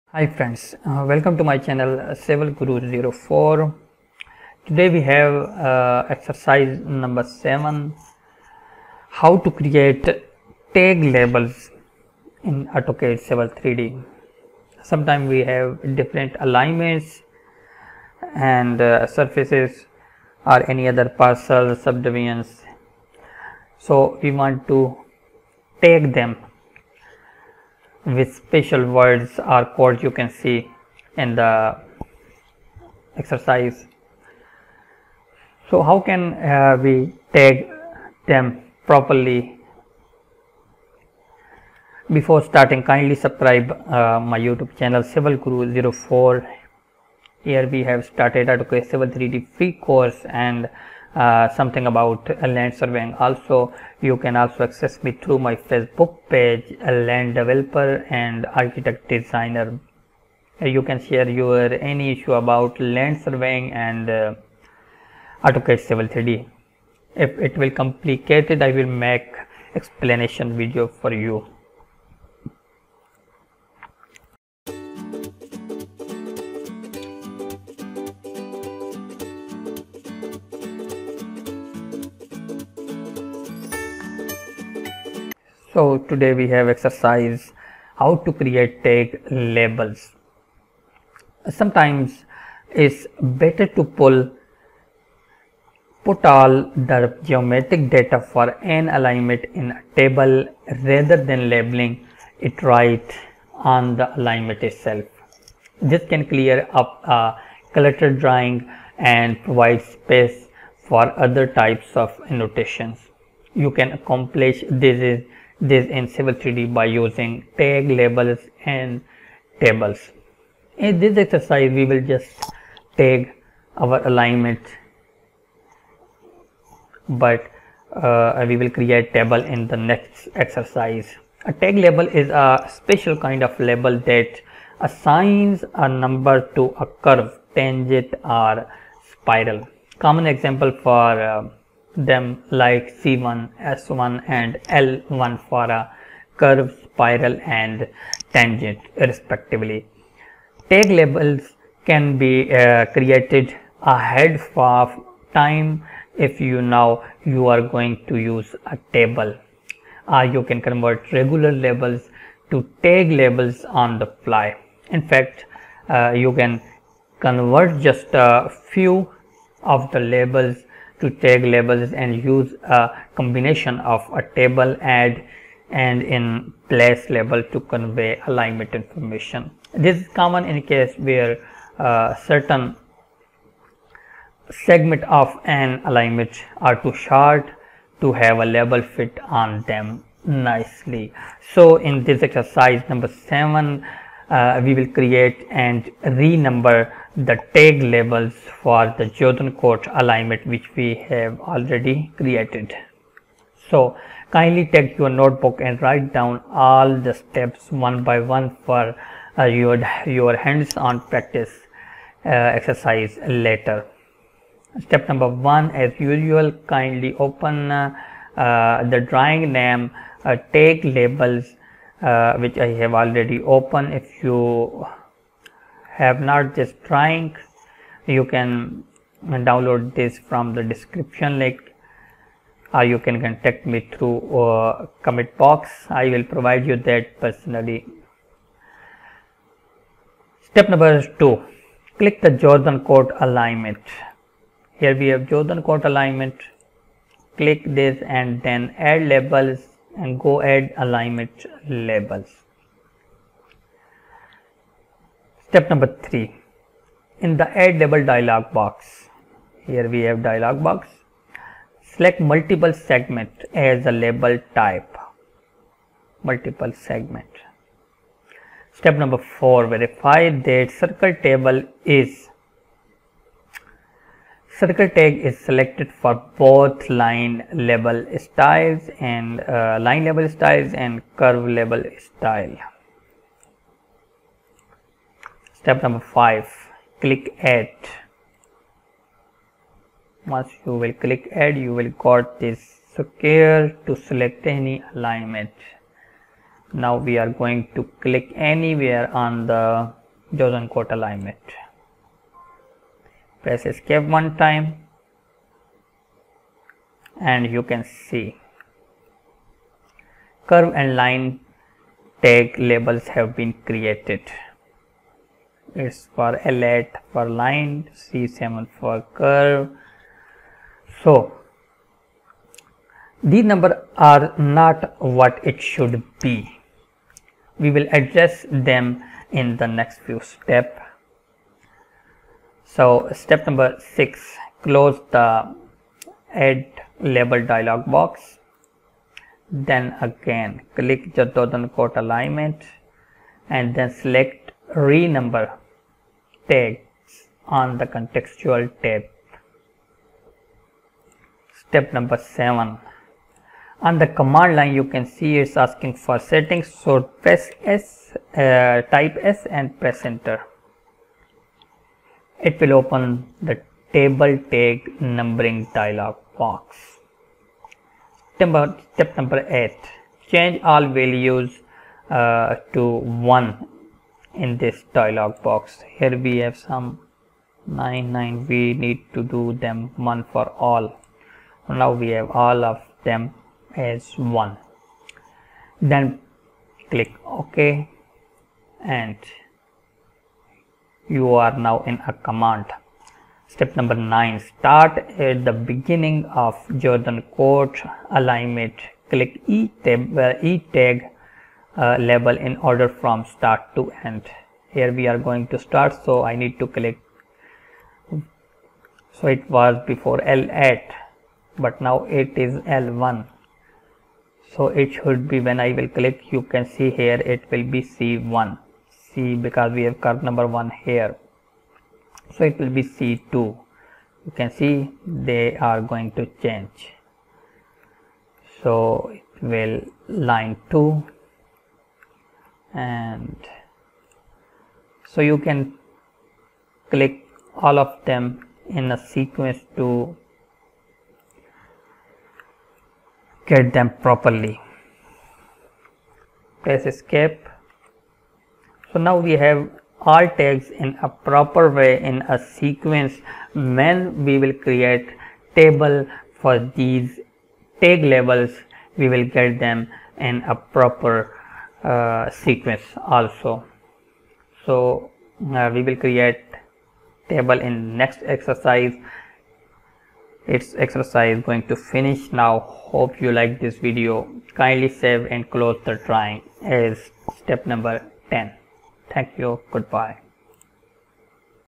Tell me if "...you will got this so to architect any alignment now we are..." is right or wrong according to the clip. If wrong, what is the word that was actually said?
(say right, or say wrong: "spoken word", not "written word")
wrong: "select", not "architect".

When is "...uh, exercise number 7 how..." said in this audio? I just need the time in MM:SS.
00:05.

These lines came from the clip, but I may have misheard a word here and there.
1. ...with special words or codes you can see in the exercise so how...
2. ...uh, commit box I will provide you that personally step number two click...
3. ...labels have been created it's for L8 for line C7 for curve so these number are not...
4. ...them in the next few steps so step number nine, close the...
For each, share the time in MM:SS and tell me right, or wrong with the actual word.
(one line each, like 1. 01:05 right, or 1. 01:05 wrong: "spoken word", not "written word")
1. 00:28 right
2. 03:54 right
3. 05:12 right
4. 05:28 wrong: "six", not "nine".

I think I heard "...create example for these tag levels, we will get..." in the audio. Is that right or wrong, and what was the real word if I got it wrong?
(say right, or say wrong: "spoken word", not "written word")
wrong: "table", not "example".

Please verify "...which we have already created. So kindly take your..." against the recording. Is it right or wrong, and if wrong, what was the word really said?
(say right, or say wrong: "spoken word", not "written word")
right.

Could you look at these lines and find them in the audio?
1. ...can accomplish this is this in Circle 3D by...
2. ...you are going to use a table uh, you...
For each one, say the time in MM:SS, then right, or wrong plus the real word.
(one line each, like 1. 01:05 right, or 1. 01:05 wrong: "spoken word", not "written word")
1. 01:53 wrong: "Civil", not "Circle"
2. 02:37 right.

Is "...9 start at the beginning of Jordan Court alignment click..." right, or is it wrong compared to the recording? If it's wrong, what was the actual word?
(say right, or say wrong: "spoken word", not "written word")
right.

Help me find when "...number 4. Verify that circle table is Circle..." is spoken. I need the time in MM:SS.
04:28.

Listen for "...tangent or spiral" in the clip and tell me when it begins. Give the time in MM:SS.
02:17.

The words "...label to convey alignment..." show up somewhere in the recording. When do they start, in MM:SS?
02:57.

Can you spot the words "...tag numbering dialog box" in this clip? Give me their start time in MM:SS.
06:04.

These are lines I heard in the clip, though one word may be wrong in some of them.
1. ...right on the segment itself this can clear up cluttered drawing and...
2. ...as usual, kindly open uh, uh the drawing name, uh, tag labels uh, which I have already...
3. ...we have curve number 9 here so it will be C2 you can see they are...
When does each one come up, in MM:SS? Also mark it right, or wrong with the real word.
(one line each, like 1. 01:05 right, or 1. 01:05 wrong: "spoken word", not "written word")
1. 01:42 wrong: "alignment", not "segment"
2. 03:35 right
3. 06:59 wrong: "1", not "9".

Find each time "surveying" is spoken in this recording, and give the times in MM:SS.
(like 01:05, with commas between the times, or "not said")
00:52, 01:03.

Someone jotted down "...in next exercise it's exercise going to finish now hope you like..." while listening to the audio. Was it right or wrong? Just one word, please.
right.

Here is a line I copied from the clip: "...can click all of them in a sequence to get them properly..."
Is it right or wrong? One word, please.
right.